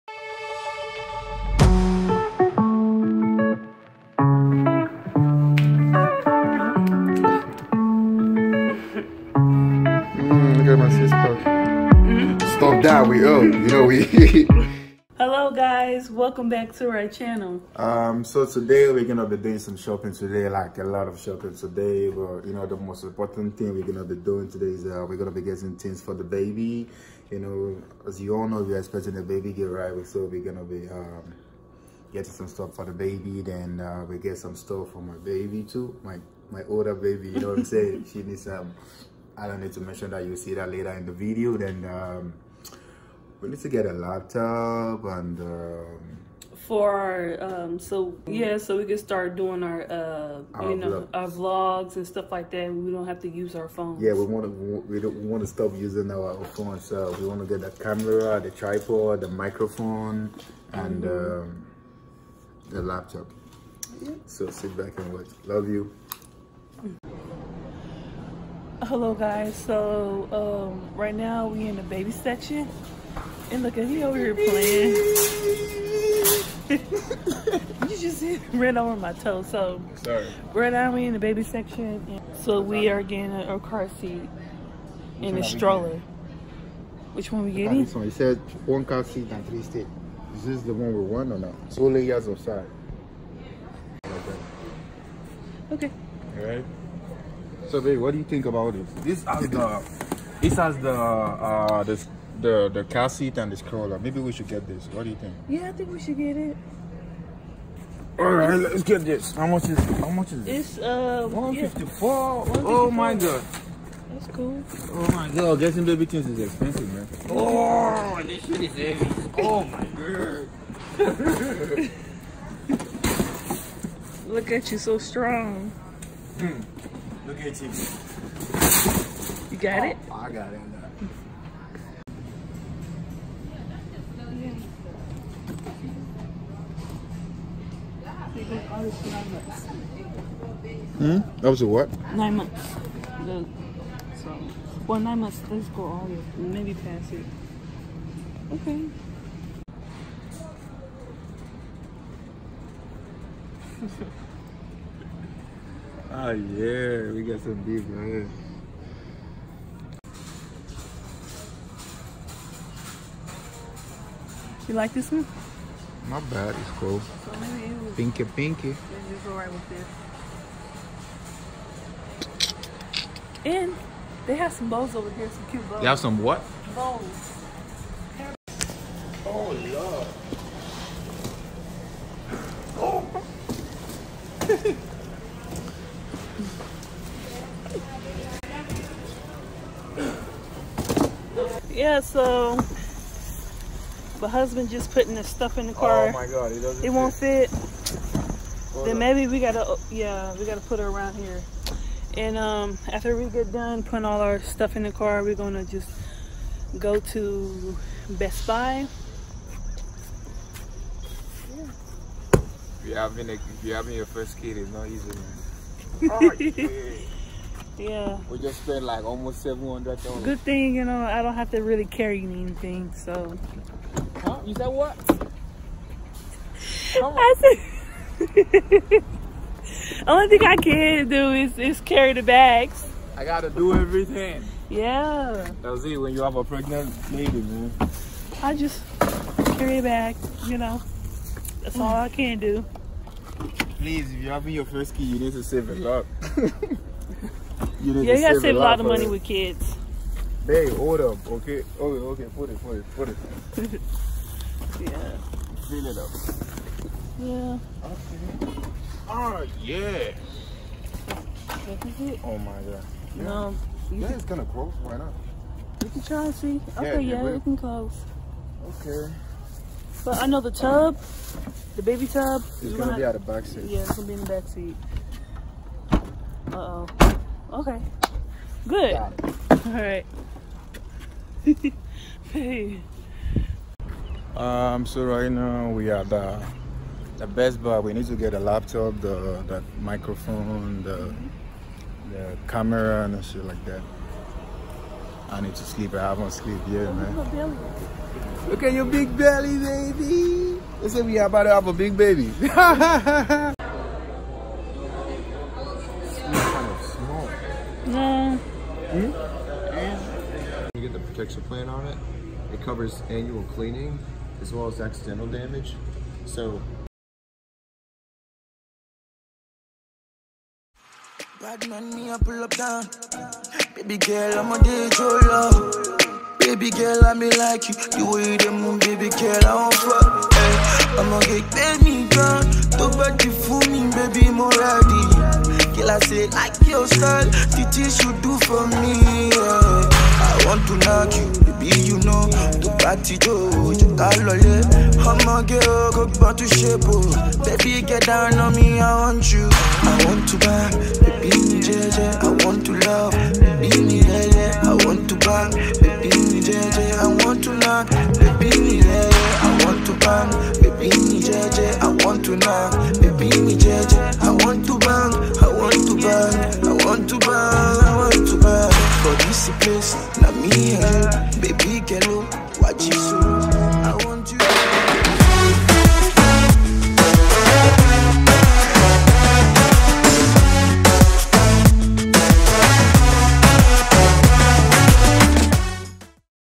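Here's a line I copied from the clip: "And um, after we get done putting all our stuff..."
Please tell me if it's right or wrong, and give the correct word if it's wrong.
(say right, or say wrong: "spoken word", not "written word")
right.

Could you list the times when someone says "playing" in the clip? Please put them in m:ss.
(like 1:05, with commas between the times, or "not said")
1:14.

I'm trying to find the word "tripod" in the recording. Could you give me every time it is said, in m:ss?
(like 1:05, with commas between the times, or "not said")
0:58.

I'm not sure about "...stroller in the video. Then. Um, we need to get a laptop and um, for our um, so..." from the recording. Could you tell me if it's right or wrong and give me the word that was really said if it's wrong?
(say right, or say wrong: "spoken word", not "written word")
wrong: "later", not "stroller".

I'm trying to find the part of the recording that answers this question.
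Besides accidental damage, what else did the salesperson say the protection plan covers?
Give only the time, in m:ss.
5:13.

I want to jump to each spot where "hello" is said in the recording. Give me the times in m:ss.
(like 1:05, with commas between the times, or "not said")
0:15, 1:08.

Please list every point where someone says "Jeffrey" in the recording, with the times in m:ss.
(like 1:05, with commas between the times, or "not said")
not said.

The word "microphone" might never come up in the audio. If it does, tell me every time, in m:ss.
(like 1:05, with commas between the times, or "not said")
0:59, 4:49.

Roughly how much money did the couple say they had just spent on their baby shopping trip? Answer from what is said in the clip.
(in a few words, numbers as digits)
almost $700.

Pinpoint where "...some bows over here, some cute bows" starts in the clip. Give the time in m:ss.
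2:54.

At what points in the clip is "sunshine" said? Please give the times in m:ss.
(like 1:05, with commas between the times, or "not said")
not said.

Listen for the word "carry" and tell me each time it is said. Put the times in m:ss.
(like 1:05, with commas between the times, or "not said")
3:41, 3:51, 3:59.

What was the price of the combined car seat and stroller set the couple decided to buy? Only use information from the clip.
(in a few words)
154.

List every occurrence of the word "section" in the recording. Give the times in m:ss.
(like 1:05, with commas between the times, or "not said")
1:12, 1:21.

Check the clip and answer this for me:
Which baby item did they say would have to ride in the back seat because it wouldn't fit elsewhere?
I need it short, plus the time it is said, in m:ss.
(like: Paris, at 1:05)
baby tub, at 4:31.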